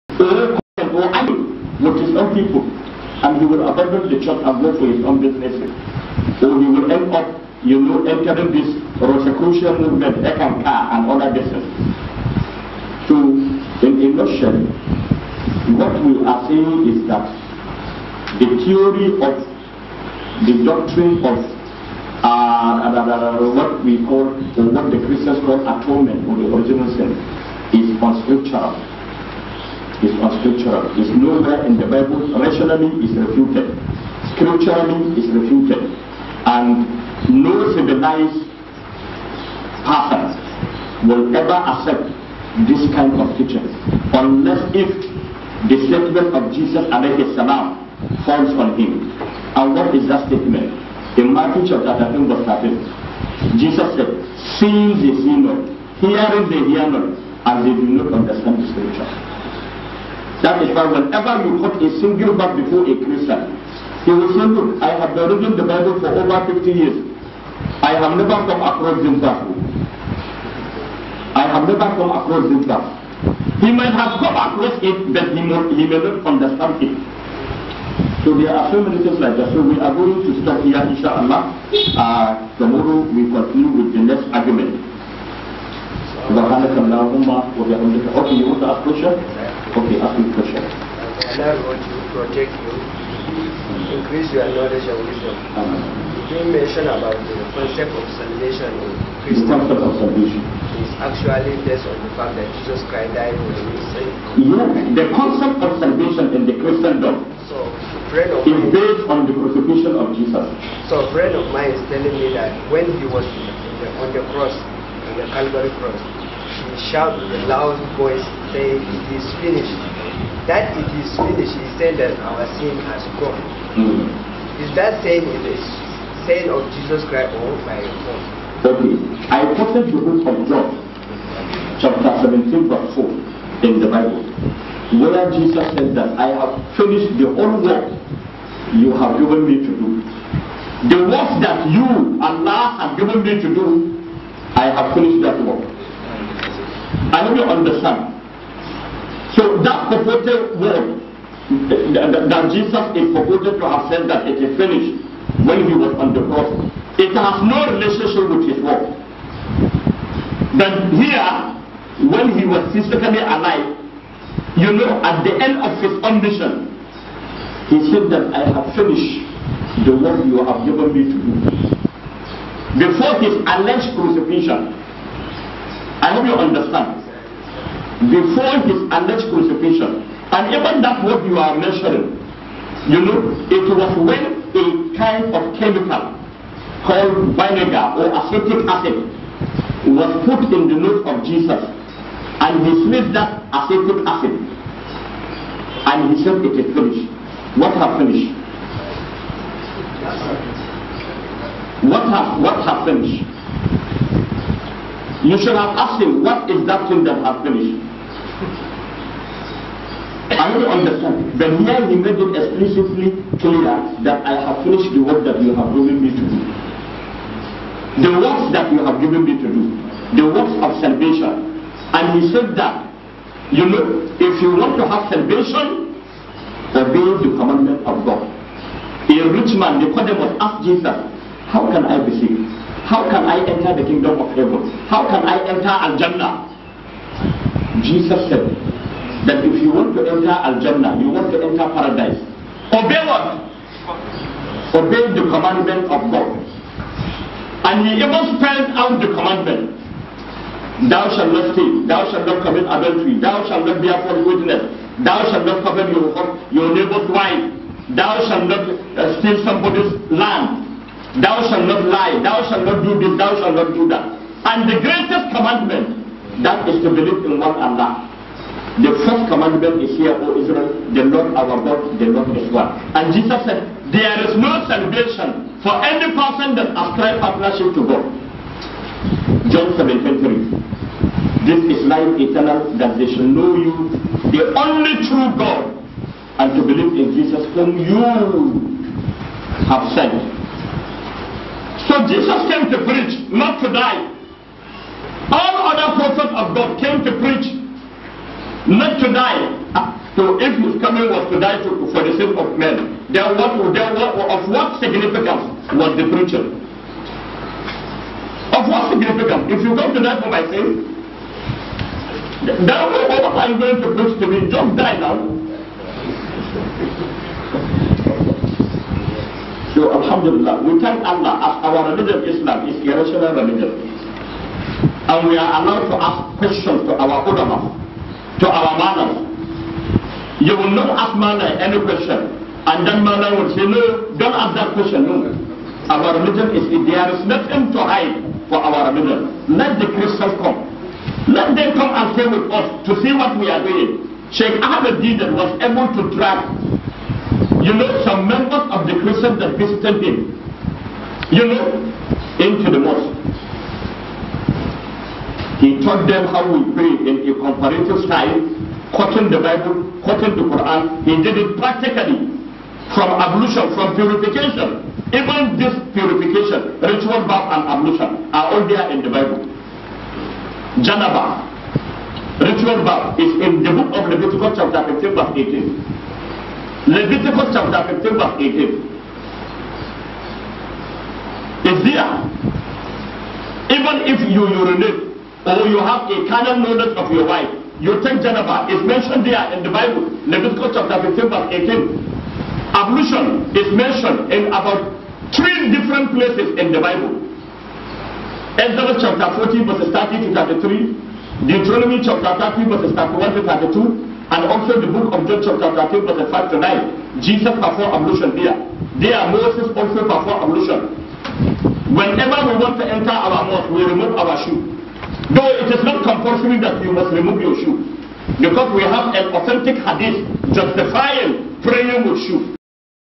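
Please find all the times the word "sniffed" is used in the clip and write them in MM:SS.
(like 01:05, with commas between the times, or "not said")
03:12.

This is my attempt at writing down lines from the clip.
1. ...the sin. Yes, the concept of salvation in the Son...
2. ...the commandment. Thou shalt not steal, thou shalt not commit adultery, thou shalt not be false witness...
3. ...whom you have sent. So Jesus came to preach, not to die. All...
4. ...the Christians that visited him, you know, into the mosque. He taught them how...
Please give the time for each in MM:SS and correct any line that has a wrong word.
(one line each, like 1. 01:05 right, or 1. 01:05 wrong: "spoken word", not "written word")
1. 01:43 wrong: "Christian", not "Son"
2. 04:08 right
3. 04:47 right
4. 05:48 right.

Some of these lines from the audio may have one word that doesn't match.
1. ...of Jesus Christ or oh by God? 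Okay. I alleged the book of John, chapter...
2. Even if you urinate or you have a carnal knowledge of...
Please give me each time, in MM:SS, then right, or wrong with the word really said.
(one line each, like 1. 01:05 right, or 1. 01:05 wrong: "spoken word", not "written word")
1. 02:06 wrong: "quoted", not "alleged"
2. 06:23 right.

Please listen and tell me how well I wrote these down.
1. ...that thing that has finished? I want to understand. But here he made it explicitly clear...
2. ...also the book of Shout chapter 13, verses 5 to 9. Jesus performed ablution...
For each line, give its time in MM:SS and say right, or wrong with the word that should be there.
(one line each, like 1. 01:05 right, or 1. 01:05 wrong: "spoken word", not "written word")
1. 03:26 right
2. 06:44 wrong: "John", not "Shout".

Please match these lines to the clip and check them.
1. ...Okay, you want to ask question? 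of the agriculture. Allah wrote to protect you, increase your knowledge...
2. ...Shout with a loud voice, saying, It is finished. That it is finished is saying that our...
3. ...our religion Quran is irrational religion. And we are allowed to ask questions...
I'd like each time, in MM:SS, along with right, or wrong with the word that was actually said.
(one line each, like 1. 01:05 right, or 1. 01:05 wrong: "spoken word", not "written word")
1. 01:28 right
2. 01:56 right
3. 05:21 wrong: "Islam", not "Quran".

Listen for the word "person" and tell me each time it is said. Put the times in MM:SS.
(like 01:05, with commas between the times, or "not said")
00:39, 04:36.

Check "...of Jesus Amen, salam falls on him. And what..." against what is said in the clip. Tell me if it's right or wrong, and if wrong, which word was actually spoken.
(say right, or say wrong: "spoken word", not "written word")
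right.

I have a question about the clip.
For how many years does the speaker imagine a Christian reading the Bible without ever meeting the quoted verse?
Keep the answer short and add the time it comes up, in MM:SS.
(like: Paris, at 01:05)
50, at 01:06.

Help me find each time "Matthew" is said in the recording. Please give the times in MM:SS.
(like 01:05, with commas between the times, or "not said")
00:51.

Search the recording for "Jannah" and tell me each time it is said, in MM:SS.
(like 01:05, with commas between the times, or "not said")
03:55, 04:00.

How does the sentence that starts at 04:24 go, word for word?
And the greatest commandment, that is to believe in one Allah.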